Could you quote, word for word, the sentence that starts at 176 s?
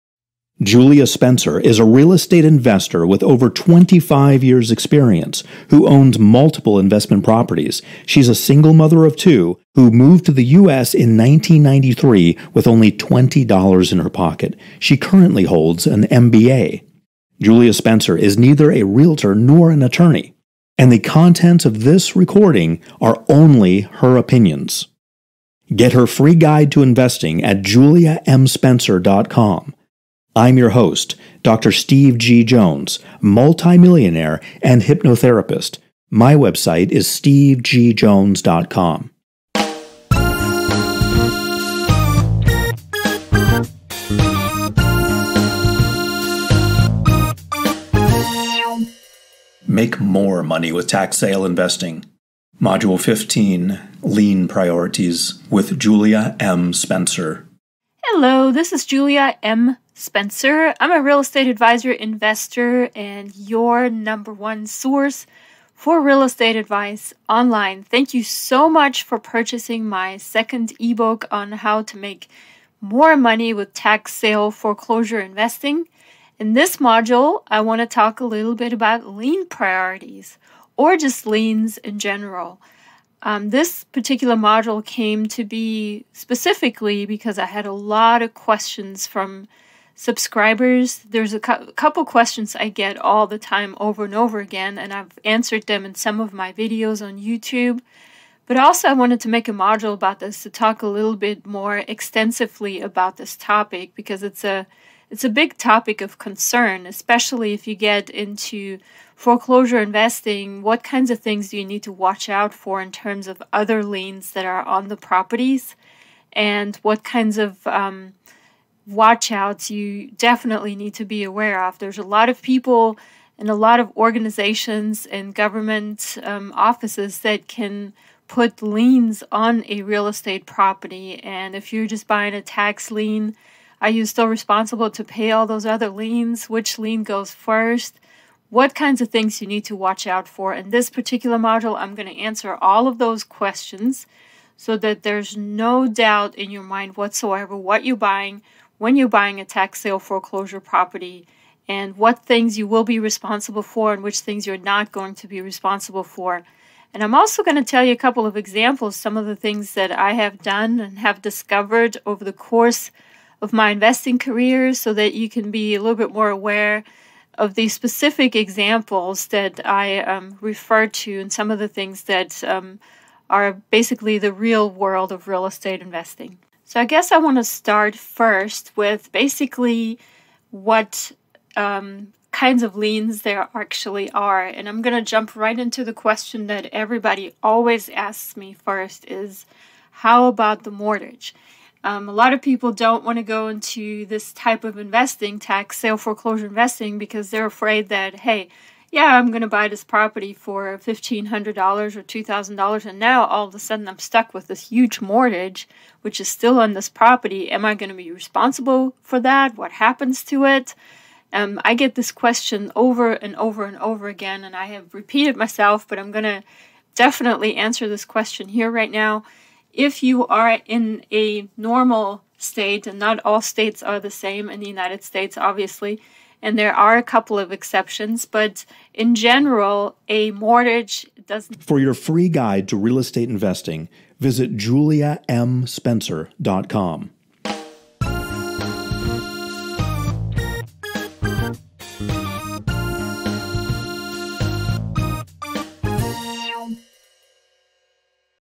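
So I guess I want to start first with basically what um, kinds of liens there actually are.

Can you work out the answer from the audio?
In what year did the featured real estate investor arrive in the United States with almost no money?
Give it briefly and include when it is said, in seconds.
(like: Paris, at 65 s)
1993, at 11 s.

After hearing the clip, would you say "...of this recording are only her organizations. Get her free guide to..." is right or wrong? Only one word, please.
wrong.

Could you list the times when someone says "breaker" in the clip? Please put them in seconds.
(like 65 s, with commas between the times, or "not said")
not said.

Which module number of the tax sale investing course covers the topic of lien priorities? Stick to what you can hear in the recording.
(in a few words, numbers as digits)
15.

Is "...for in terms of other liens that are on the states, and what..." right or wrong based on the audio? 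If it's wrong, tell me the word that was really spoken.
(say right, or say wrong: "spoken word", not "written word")
wrong: "properties", not "states".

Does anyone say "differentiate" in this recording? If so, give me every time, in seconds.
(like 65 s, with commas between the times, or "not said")
not said.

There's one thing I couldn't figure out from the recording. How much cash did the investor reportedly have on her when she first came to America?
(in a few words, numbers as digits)
$20.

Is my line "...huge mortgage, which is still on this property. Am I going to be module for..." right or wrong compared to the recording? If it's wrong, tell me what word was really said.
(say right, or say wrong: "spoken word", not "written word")
wrong: "responsible", not "module".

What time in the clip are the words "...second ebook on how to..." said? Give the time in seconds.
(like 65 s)
70 s.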